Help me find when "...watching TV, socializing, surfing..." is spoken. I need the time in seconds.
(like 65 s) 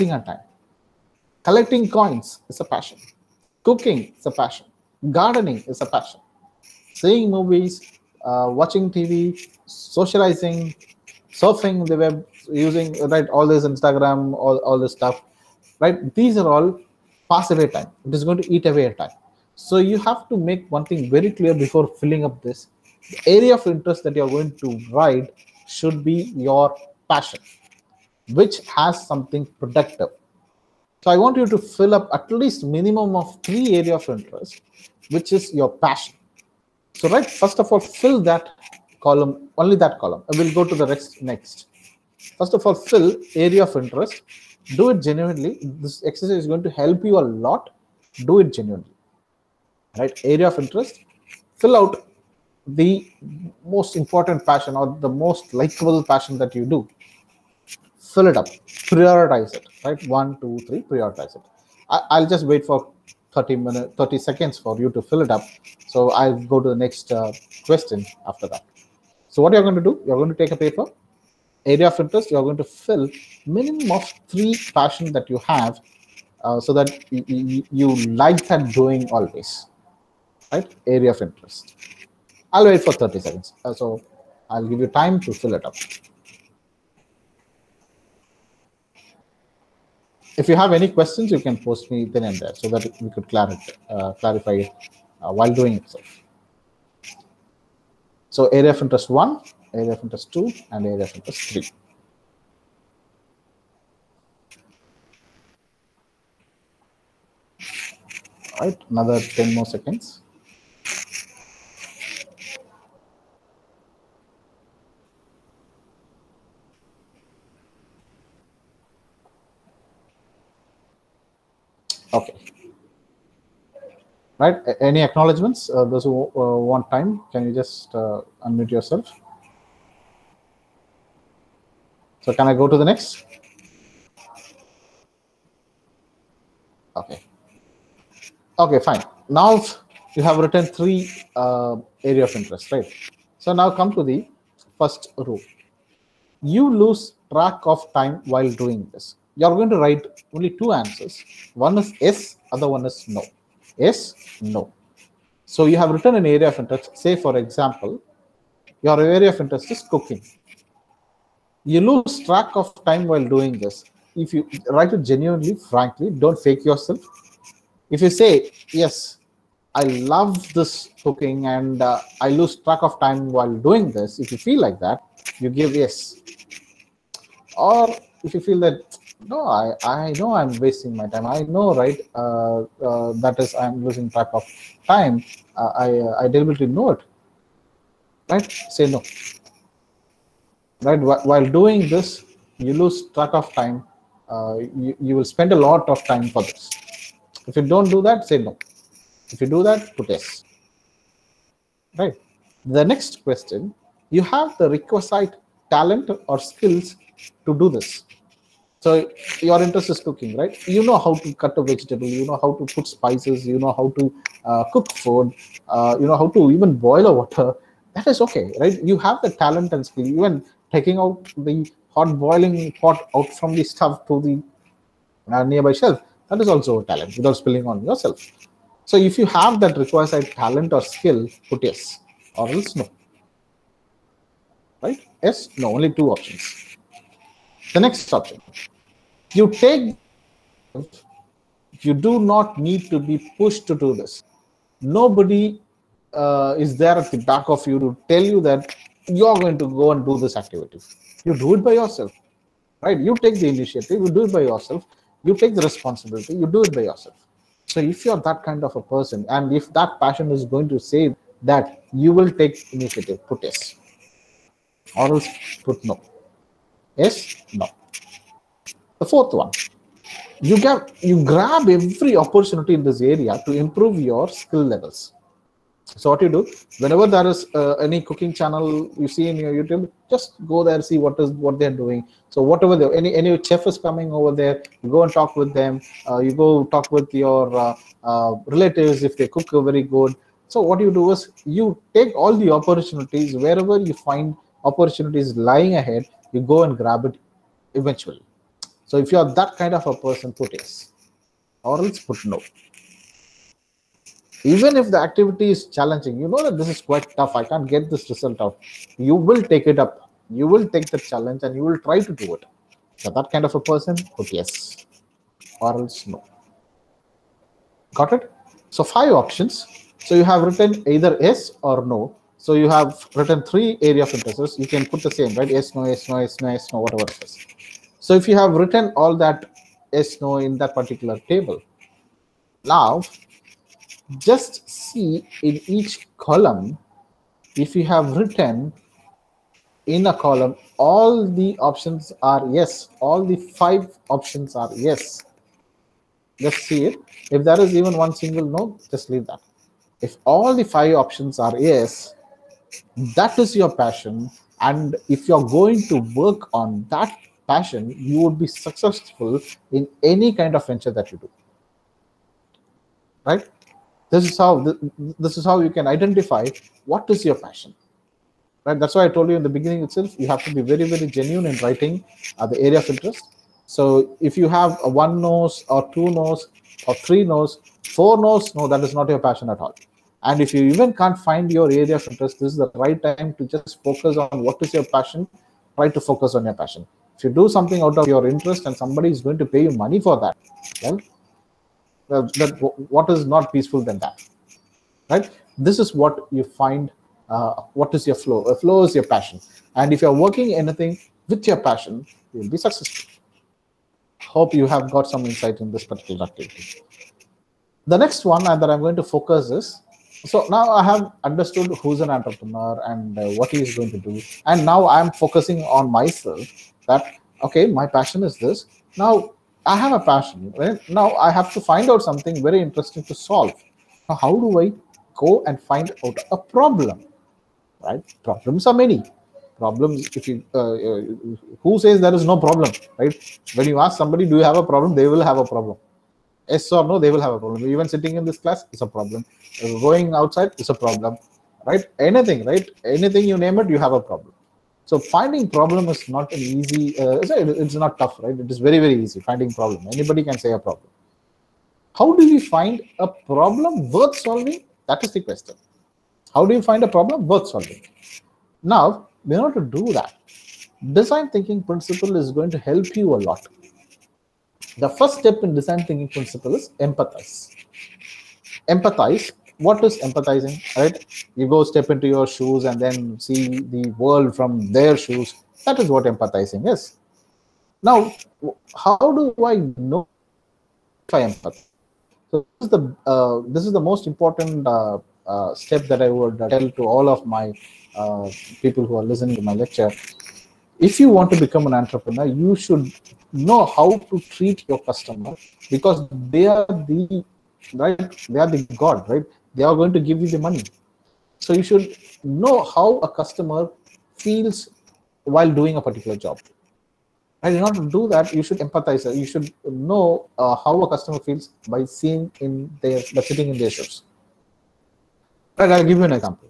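8 s.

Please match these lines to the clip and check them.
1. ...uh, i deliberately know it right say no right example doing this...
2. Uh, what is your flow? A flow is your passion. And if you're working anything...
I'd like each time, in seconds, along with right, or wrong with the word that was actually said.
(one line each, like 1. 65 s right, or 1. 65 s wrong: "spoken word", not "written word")
1. 185 s wrong: "while", not "example"
2. 397 s right.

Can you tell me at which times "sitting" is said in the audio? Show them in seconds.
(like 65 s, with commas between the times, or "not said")
437 s, 513 s.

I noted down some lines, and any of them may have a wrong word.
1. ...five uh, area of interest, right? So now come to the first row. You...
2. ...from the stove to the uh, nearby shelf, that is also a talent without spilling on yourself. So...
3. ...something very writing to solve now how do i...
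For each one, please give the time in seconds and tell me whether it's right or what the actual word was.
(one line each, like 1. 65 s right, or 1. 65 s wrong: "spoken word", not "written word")
1. 140 s wrong: "three", not "five"
2. 223 s right
3. 422 s wrong: "interesting", not "writing".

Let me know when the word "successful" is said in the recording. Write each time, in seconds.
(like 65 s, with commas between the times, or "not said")
358 s, 402 s.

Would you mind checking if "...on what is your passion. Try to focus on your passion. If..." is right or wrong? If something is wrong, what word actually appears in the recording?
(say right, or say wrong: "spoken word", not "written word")
right.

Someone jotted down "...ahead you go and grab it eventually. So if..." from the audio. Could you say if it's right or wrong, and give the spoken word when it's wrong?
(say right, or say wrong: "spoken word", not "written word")
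right.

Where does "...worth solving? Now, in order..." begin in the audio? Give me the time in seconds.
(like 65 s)
457 s.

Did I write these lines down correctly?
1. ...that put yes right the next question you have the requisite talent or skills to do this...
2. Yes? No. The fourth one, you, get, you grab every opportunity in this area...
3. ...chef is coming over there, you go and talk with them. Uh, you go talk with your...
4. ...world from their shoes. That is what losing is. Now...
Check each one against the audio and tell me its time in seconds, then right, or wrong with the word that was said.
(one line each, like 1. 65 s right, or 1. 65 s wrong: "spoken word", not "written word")
1. 199 s right
2. 266 s right
3. 283 s right
4. 473 s wrong: "empathizing", not "losing".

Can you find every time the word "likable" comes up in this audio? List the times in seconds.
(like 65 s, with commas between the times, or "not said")
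55 s.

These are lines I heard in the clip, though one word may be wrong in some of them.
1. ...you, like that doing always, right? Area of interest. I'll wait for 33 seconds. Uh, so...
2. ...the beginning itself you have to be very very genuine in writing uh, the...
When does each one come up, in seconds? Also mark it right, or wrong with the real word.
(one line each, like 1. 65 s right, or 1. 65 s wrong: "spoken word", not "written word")
1. 77 s wrong: "30", not "33"
2. 369 s right.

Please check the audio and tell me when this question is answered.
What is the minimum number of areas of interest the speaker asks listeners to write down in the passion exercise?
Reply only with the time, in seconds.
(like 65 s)
32 s.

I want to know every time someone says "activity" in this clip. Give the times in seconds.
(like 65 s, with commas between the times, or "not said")
250 s, 304 s, 406 s.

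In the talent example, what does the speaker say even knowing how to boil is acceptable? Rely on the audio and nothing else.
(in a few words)
Water.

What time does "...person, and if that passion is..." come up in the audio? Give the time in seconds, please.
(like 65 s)
258 s.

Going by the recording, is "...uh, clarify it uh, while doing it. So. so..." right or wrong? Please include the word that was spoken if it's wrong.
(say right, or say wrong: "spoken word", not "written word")
right.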